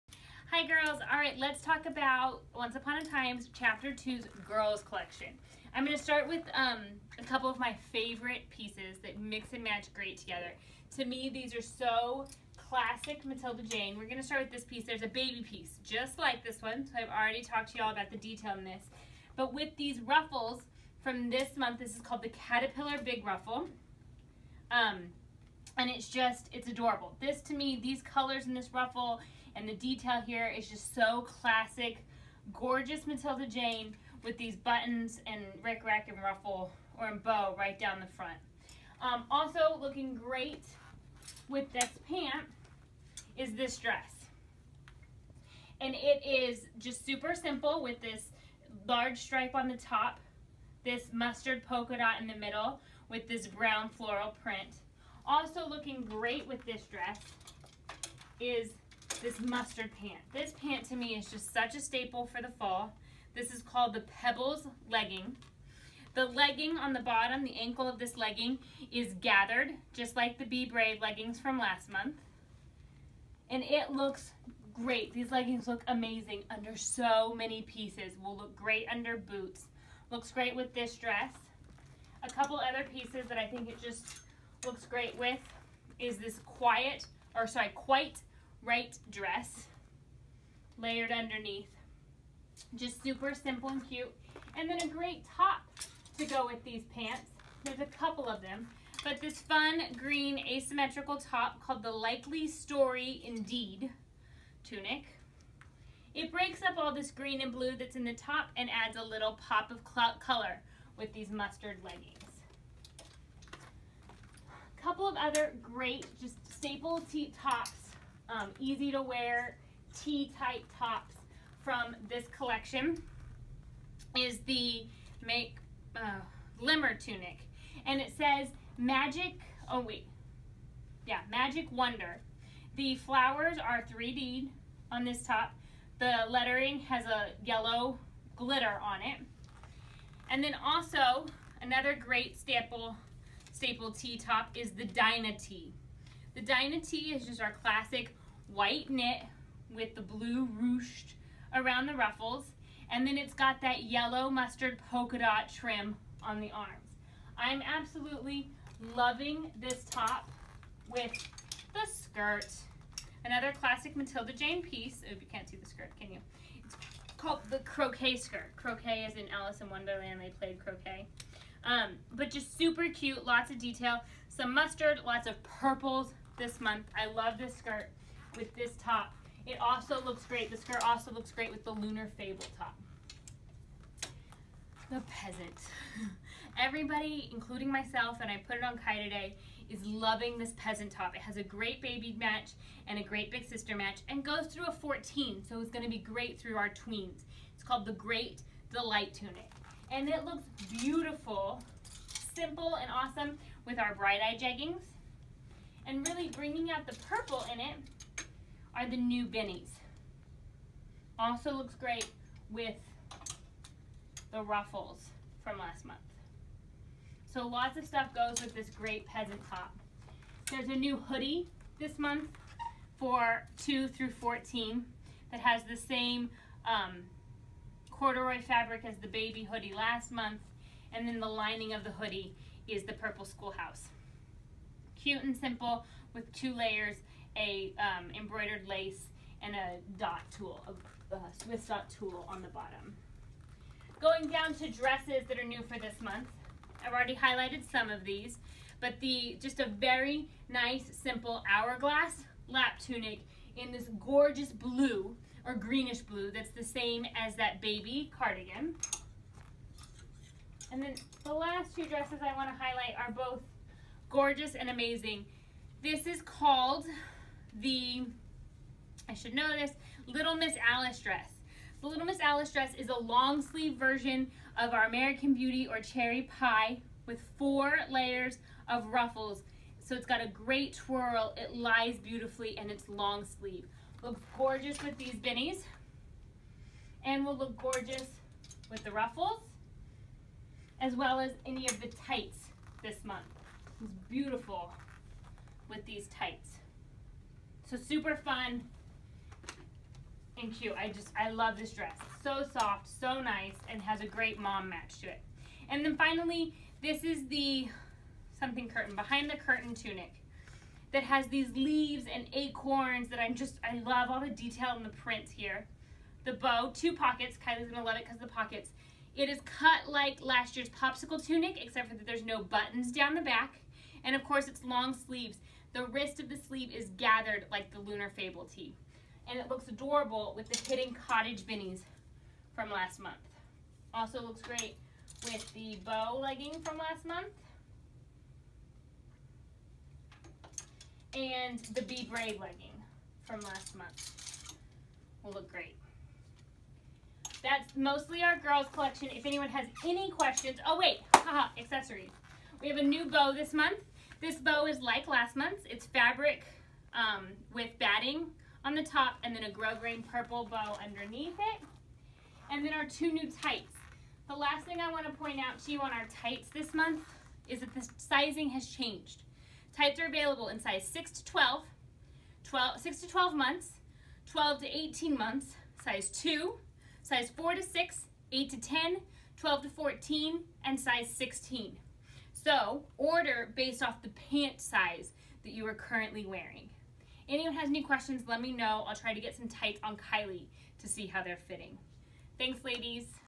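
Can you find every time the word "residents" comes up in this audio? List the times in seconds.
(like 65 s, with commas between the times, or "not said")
not said.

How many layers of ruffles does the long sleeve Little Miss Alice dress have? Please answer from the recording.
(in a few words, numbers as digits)
4.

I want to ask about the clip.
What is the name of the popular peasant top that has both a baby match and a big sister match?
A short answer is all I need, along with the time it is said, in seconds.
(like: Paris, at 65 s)
Great Delight Tunic, at 197 s.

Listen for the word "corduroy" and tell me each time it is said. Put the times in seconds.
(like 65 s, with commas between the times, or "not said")
227 s.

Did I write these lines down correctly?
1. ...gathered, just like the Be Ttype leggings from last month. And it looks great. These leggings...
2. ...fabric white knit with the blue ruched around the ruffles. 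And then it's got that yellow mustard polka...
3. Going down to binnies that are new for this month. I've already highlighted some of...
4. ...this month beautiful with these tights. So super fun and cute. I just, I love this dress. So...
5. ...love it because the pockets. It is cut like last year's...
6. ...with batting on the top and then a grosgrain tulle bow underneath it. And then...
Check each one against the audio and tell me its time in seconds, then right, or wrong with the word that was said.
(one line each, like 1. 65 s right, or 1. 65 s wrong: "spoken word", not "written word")
1. 69 s wrong: "Brave", not "Ttype"
2. 147 s wrong: "classic", not "fabric"
3. 243 s wrong: "dresses", not "binnies"
4. 292 s right
5. 317 s right
6. 357 s wrong: "purple", not "tulle".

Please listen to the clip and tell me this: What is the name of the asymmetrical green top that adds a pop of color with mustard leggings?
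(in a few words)
Likely Story Indeed tunic.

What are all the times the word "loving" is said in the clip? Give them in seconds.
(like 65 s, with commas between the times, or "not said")
158 s, 189 s.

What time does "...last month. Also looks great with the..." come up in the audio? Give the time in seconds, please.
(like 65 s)
332 s.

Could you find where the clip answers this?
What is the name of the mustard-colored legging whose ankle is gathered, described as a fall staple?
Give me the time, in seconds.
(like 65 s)
64 s.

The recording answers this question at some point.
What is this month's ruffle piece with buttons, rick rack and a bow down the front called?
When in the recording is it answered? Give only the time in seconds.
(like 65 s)
22 s.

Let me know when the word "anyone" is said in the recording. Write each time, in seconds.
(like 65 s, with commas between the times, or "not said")
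349 s, 387 s.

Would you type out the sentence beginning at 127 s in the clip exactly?
And it says magic, oh wait, yeah, magic wonder.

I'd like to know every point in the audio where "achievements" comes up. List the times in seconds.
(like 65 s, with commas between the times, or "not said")
not said.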